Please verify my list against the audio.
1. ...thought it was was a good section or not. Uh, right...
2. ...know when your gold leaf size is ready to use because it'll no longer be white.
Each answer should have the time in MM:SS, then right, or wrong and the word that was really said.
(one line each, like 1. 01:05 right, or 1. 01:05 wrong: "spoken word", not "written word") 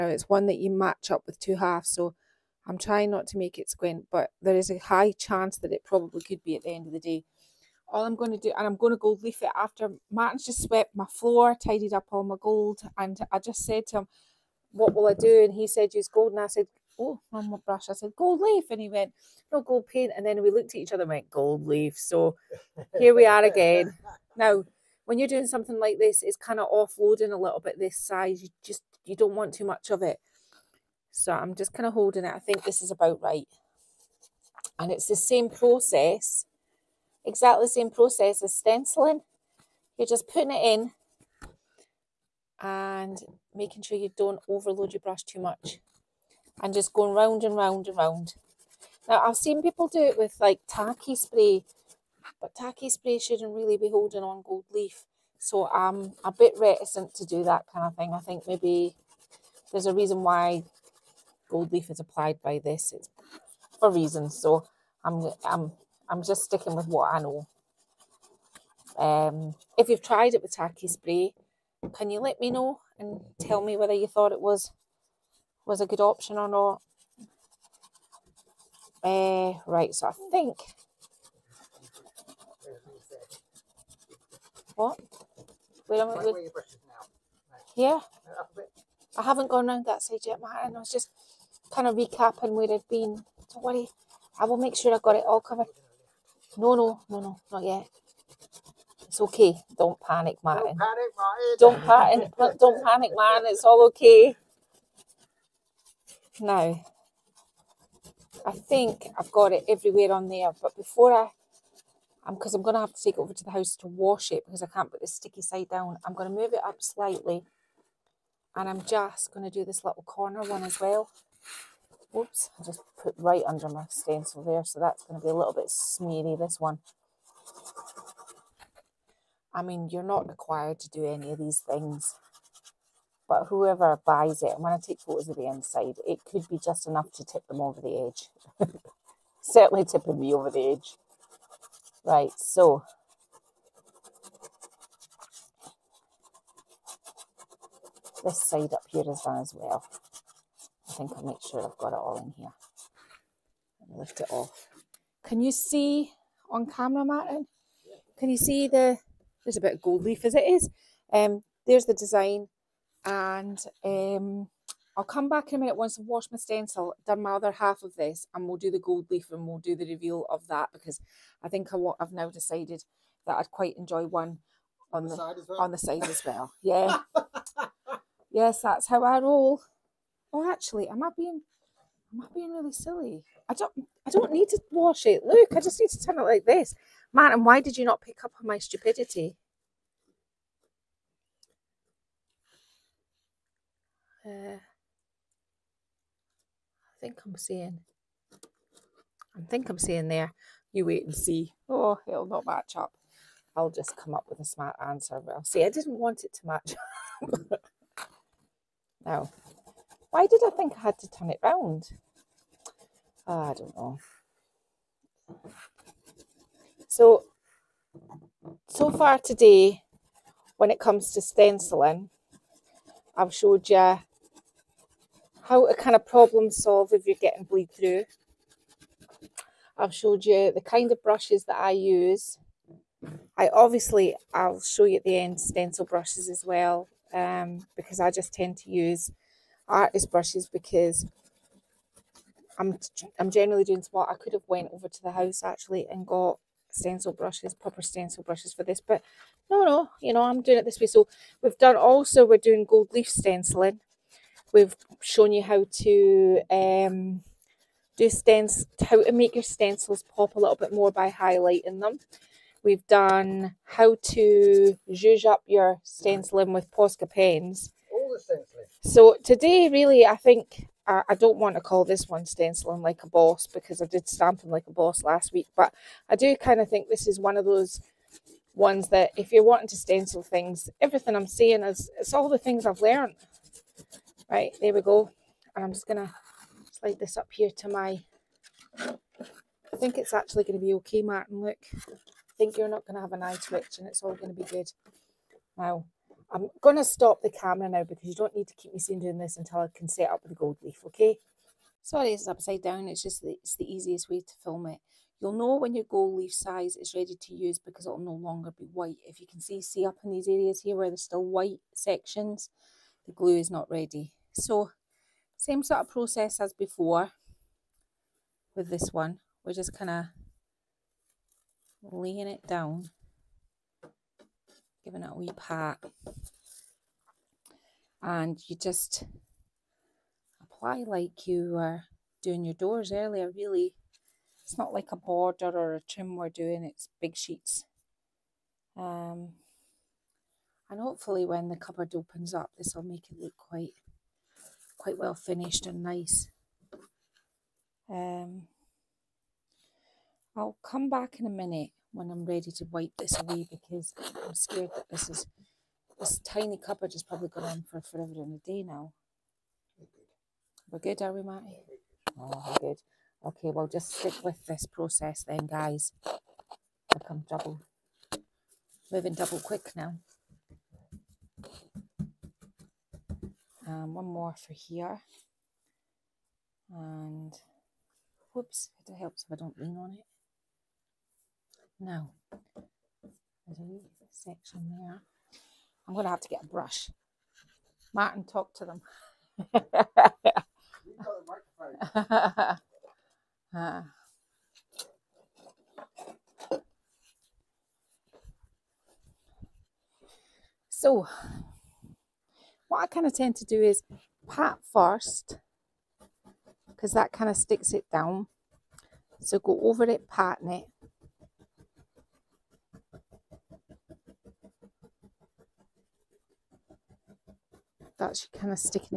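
1. 01:14 wrong: "option", not "section"
2. 05:05 right.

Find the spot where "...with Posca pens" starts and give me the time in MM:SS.
04:26.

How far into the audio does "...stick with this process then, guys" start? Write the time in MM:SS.
06:03.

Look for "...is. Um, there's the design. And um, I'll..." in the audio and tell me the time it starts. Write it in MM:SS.
02:40.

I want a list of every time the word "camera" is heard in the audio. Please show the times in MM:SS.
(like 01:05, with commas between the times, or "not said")
02:36, 04:57.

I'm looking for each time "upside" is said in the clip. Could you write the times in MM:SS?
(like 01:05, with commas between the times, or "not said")
05:02.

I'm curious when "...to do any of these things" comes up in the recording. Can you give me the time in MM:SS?
02:10.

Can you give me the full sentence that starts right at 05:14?
So same sort of process as before with this one.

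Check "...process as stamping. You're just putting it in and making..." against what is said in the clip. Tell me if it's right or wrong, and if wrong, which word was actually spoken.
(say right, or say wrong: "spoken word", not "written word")
wrong: "stenciling", not "stamping".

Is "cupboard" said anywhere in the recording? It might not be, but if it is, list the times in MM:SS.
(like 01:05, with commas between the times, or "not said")
05:41, 05:56.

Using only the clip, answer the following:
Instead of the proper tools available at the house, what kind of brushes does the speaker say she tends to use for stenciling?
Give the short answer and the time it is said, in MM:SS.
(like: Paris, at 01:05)
artist brushes, at 03:59.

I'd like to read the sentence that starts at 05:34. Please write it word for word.
It's not like a border or a trim we're doing, it's big sheets.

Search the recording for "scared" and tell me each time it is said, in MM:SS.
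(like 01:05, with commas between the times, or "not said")
05:54.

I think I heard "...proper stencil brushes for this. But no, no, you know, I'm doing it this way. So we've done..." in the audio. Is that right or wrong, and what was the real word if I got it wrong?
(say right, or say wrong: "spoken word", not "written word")
right.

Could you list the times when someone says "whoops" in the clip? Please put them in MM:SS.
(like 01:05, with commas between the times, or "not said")
02:02, 06:18.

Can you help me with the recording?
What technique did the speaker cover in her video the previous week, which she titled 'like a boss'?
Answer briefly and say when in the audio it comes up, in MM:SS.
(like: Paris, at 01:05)
stamping, at 04:34.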